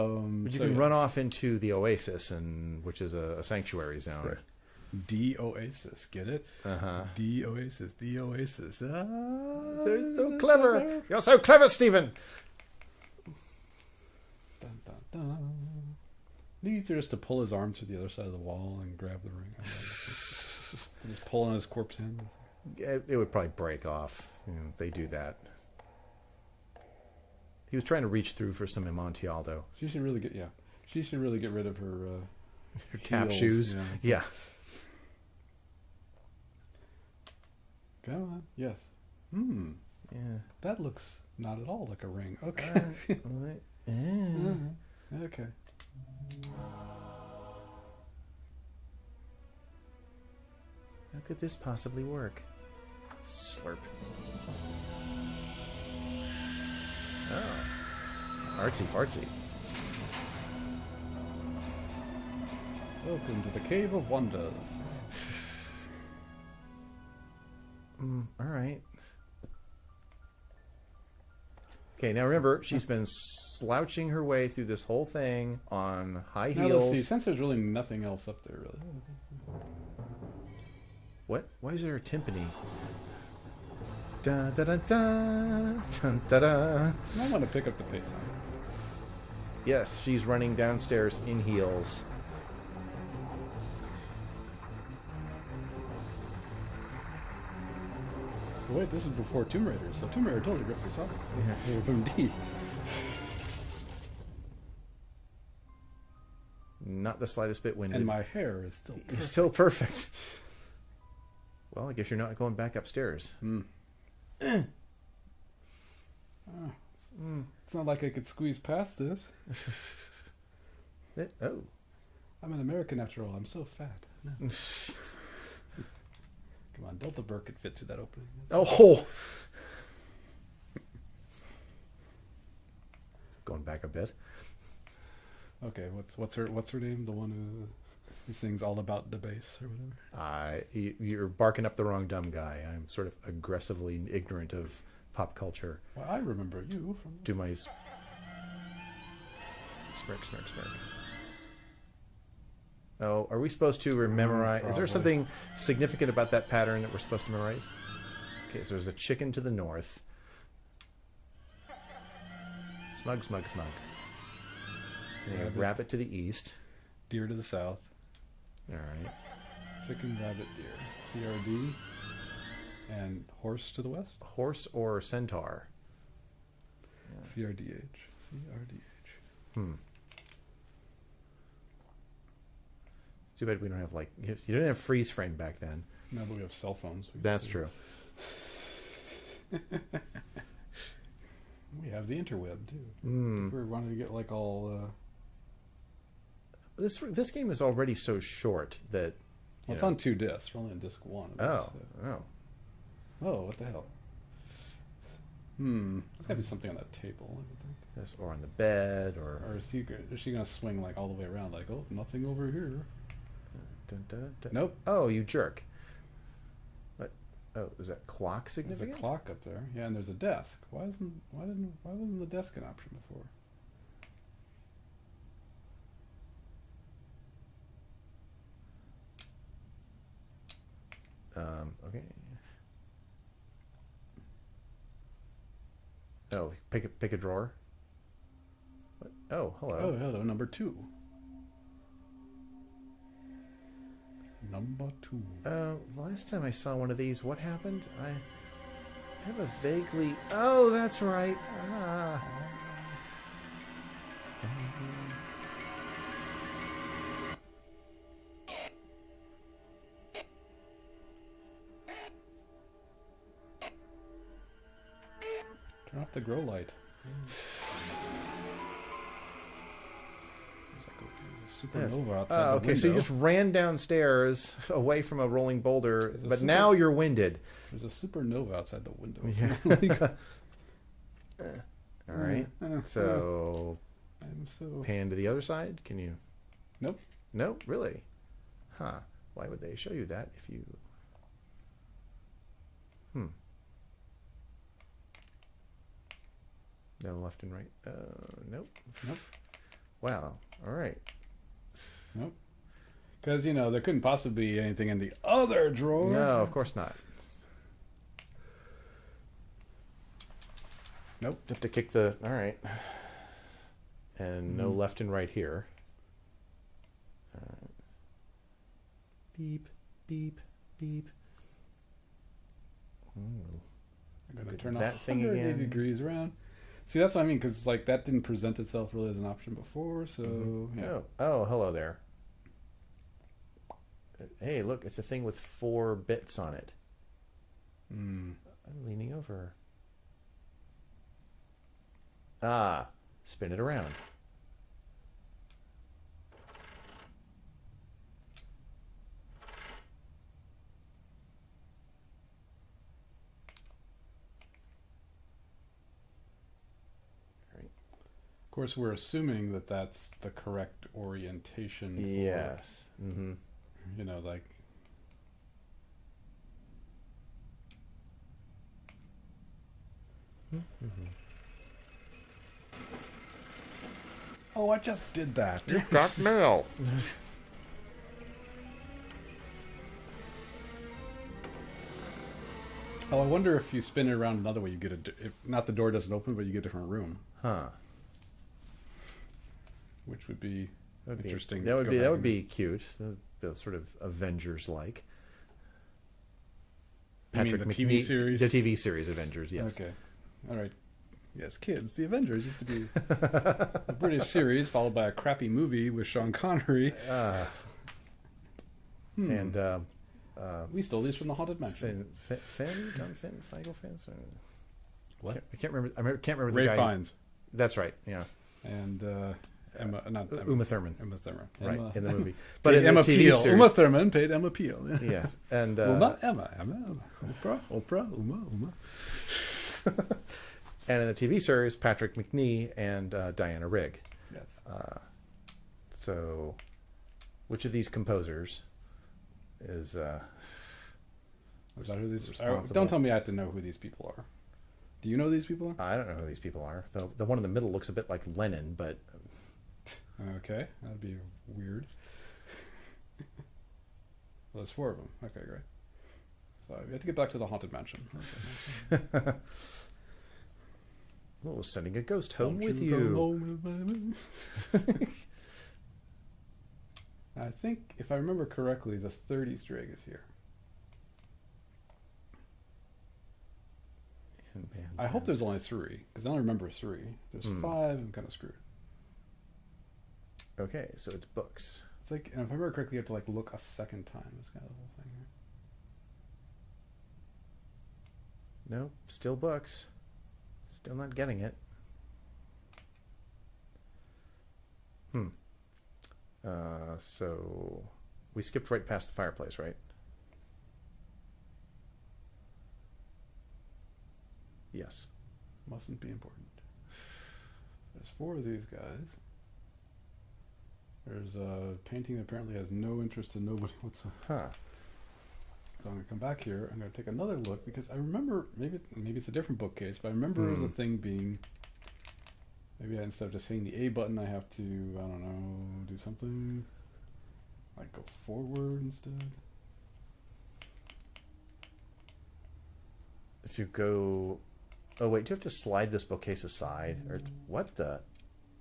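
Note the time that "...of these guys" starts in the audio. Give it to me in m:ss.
8:28.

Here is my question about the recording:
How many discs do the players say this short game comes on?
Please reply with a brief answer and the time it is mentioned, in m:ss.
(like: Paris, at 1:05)
2, at 3:19.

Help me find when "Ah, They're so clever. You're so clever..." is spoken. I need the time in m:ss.
0:08.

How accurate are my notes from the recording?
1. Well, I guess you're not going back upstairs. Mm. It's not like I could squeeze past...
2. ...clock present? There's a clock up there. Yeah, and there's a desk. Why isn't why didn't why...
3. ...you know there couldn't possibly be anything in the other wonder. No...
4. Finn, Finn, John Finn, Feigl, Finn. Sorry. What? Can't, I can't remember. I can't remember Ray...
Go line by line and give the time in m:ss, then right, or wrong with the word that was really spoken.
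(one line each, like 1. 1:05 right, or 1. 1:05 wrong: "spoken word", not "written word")
1. 1:51 right
2. 3:38 wrong: "significant", not "present"
3. 5:03 wrong: "drawer", not "wonder"
4. 6:52 right.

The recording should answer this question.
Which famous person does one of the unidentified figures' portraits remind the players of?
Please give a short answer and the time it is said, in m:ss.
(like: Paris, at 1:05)
Lennon, at 7:28.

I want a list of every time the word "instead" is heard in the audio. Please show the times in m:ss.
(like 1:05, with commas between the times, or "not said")
8:43, 8:48.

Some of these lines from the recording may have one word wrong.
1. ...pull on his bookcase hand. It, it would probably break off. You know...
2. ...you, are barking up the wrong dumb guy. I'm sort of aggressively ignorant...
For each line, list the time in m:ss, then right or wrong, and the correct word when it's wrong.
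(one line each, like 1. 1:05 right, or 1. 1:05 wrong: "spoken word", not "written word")
1. 0:21 wrong: "corpse", not "bookcase"
2. 2:20 right.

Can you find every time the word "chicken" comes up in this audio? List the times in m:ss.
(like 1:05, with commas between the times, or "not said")
2:38, 2:49.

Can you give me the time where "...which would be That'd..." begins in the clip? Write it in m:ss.
6:30.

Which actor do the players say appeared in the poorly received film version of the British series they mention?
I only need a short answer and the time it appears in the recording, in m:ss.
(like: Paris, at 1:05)
Sean Connery, at 6:46.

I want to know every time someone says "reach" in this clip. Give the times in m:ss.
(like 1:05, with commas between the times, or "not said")
0:28.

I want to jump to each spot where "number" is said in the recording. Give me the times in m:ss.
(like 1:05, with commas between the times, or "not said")
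4:00, 4:04.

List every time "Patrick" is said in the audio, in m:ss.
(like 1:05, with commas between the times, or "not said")
6:37, 7:11.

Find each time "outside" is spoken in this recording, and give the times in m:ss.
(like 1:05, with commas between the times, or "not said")
4:32, 4:38.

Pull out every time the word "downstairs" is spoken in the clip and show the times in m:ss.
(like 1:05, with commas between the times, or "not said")
1:30, 4:33.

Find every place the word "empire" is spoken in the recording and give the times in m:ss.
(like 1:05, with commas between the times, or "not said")
not said.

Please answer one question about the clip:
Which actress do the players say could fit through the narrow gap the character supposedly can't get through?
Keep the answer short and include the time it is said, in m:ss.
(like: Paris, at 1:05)
Delta Burke, at 2:06.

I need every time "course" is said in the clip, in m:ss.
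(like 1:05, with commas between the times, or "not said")
5:06, 5:58.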